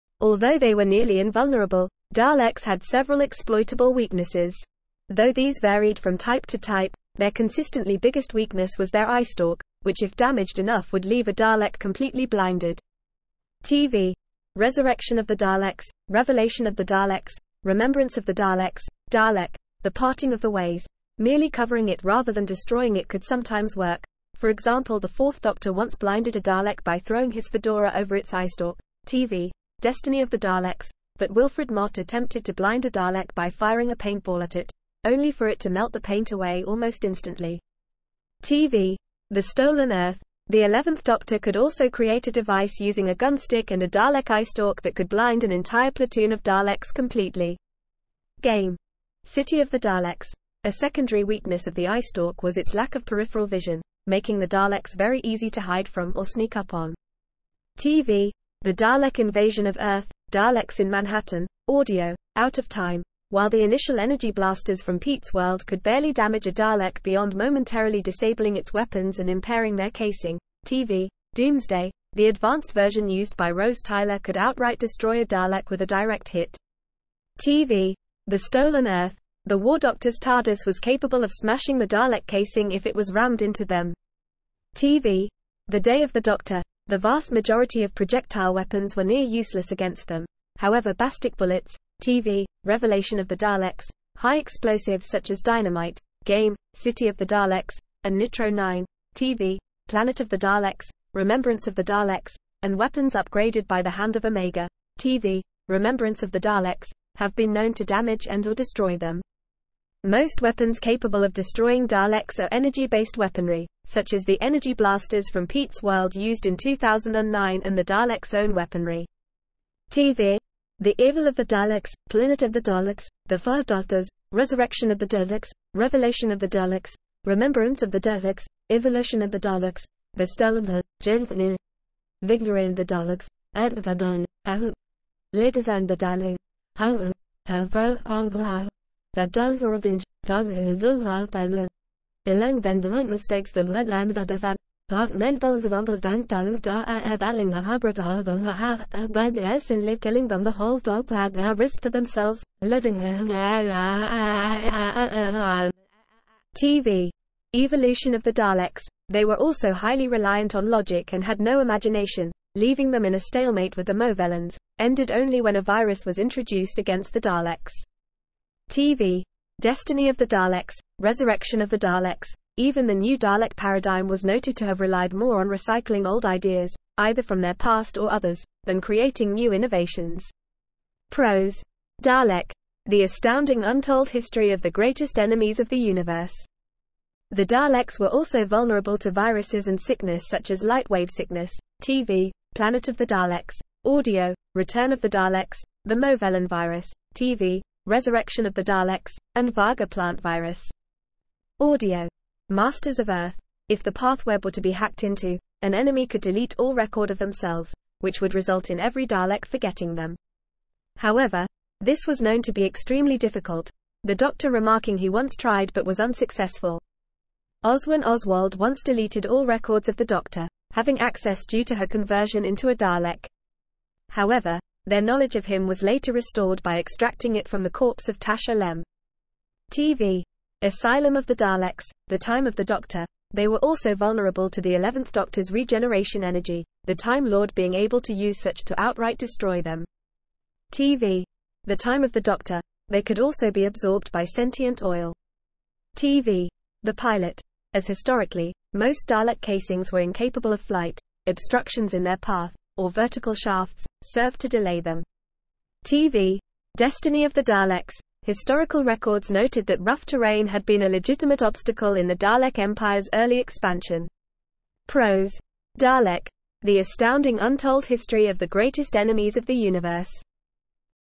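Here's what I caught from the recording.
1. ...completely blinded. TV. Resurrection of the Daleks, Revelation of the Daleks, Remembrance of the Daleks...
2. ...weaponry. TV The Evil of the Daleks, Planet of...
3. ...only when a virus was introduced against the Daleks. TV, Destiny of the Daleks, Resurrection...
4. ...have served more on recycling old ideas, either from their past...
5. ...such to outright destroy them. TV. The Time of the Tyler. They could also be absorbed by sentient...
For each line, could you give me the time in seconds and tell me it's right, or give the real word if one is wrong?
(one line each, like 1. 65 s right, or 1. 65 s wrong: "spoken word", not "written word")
1. 11 s right
2. 118 s right
3. 165 s right
4. 174 s wrong: "relied", not "served"
5. 238 s wrong: "Doctor", not "Tyler".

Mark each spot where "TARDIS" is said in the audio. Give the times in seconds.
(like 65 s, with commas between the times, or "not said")
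80 s.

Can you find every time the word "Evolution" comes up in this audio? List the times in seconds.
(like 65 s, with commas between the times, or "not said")
128 s, 157 s.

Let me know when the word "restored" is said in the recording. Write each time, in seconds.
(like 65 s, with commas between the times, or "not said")
226 s.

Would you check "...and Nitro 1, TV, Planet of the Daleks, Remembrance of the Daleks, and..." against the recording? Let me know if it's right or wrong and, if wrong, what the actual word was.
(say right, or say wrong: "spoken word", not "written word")
wrong: "9", not "1".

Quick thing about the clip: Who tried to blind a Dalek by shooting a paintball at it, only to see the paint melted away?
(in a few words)
Wilfred Mott.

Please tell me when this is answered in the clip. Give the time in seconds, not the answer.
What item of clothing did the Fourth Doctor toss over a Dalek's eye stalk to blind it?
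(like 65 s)
27 s.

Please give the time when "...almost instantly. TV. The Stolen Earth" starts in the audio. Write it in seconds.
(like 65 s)
36 s.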